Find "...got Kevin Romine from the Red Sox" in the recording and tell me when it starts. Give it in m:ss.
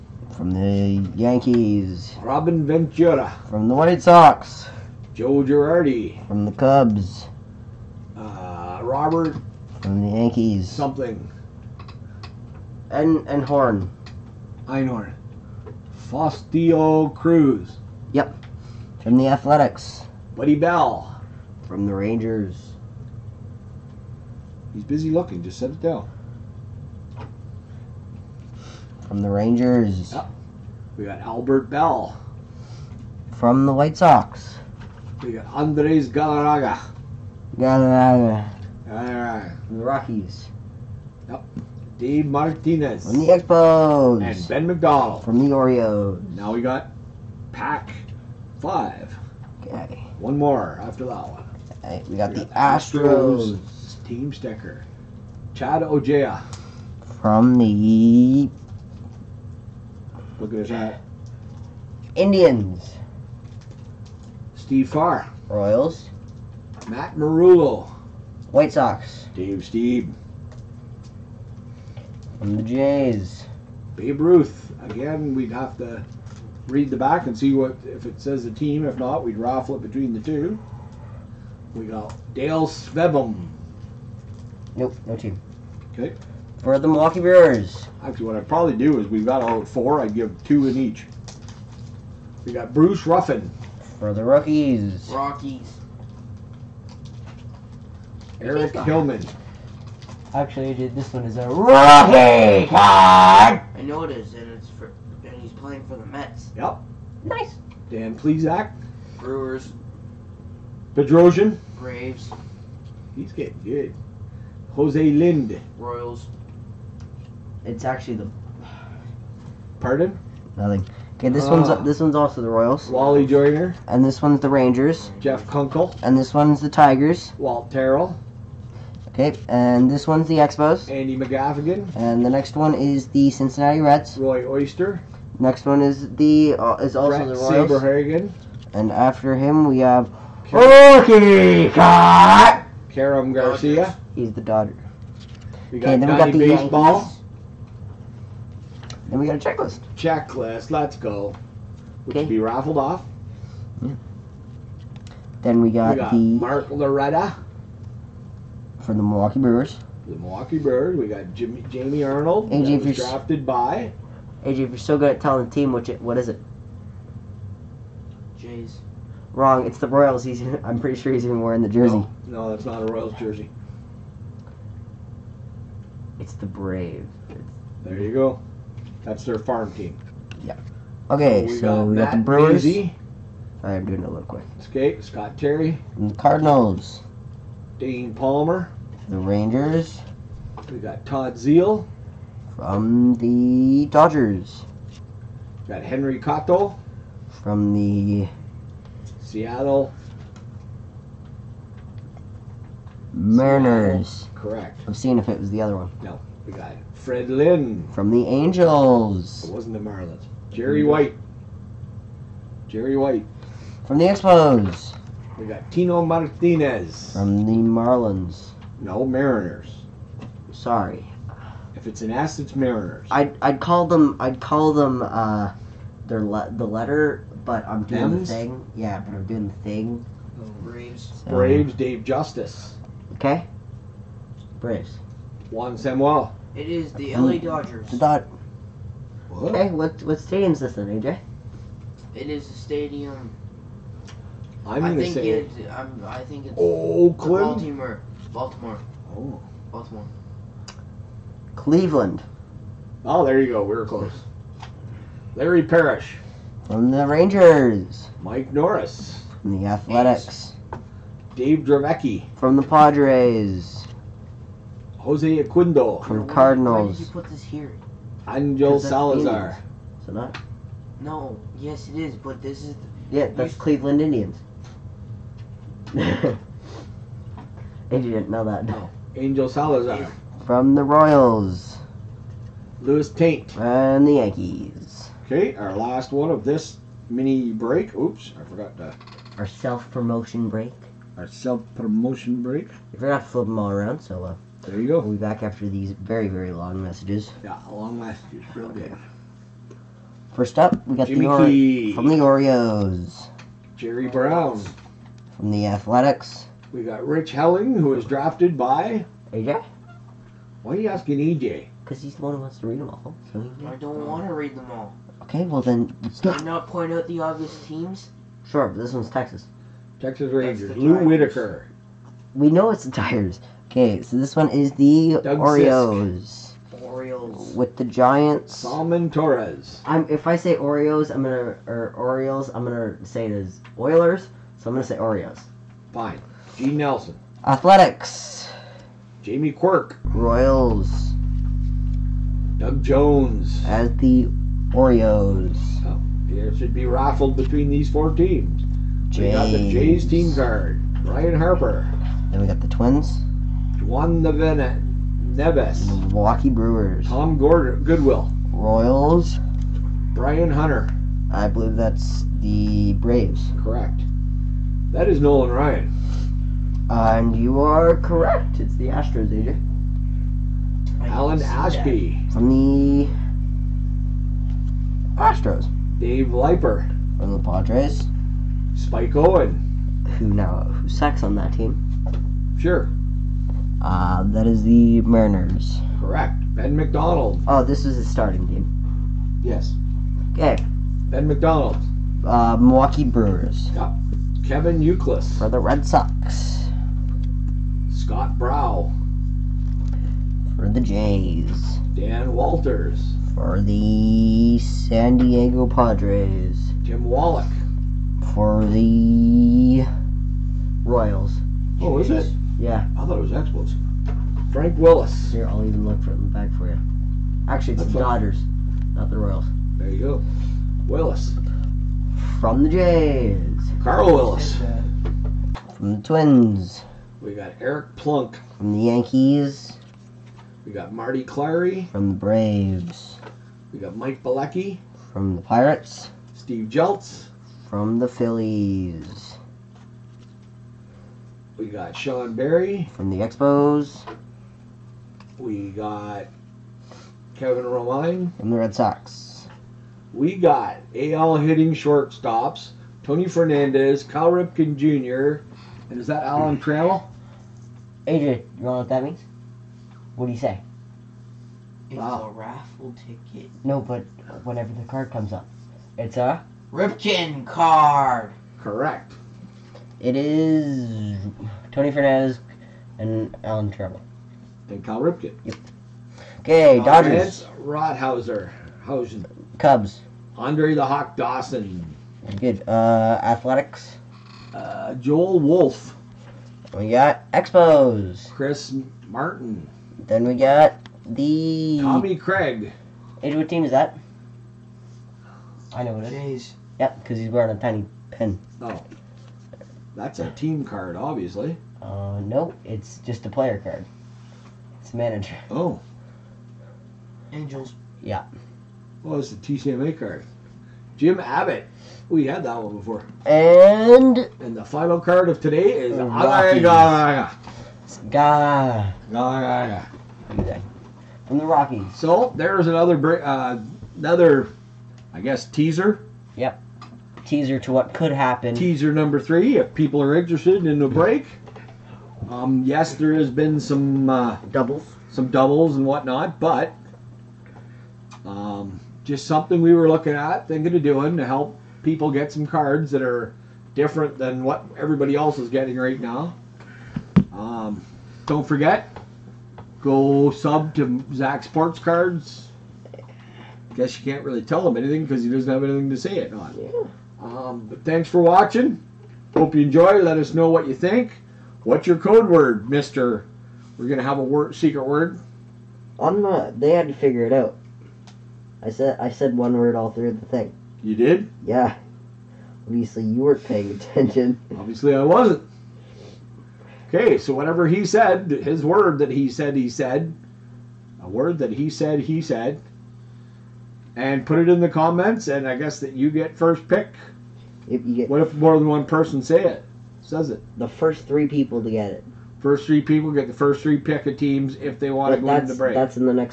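7:25.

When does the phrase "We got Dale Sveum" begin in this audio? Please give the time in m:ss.
1:21.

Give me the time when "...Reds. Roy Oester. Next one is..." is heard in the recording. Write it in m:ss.
2:13.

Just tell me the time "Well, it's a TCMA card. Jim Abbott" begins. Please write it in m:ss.
8:29.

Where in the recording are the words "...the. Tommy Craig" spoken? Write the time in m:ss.
8:11.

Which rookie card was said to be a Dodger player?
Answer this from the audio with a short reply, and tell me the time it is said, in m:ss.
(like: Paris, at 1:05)
Karim Garcia, at 2:22.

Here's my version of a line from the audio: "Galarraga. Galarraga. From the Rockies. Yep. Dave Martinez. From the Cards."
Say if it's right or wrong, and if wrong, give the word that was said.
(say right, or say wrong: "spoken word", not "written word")
wrong: "Expos", not "Cards".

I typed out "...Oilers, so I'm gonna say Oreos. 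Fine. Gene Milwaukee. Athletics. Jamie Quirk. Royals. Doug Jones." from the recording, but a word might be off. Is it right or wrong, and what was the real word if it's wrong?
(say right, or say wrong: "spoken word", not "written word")
wrong: "Nelson", not "Milwaukee".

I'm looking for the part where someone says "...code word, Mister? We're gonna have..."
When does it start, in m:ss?
9:21.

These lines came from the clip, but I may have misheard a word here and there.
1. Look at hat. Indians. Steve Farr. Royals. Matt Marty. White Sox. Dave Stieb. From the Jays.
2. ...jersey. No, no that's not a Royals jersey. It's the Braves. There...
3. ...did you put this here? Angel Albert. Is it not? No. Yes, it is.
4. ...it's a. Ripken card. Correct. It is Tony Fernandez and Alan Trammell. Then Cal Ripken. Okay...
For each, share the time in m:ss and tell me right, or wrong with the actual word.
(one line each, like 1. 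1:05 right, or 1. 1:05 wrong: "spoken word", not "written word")
1. 1:00 wrong: "Merullo", not "Marty"
2. 2:51 right
3. 4:26 wrong: "Salazar", not "Albert"
4. 7:45 right.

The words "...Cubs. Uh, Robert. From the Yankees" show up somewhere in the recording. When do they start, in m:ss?
0:06.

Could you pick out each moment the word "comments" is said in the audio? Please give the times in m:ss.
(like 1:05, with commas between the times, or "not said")
9:44.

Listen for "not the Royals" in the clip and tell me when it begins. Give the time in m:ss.
6:58.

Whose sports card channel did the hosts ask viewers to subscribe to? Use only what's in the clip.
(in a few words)
Zach's Sports Cards.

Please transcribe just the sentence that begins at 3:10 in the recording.
We got Todd Zeile from the Dodgers.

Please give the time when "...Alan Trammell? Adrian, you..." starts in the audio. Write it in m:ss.
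7:36.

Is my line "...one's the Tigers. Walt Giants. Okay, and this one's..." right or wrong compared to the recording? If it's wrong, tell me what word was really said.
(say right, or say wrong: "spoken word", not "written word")
wrong: "Terrell", not "Giants".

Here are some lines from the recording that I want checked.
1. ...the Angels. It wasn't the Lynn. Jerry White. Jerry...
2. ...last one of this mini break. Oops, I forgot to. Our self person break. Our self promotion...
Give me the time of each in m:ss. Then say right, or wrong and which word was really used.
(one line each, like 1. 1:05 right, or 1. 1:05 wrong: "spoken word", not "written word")
1. 3:28 wrong: "Marlins", not "Lynn"
2. 4:45 wrong: "promotion", not "person".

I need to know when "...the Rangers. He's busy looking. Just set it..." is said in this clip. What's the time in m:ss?
0:21.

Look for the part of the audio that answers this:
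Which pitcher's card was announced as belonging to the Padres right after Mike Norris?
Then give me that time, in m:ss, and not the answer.
4:21.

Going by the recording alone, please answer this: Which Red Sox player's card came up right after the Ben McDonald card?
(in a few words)
Kevin Youkilis.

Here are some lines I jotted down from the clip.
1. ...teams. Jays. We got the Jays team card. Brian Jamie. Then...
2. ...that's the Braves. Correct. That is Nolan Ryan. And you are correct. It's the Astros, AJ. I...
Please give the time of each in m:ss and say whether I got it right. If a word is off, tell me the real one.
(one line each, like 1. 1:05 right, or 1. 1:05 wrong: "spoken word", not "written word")
1. 5:48 wrong: "Harper", not "Jamie"
2. 6:01 right.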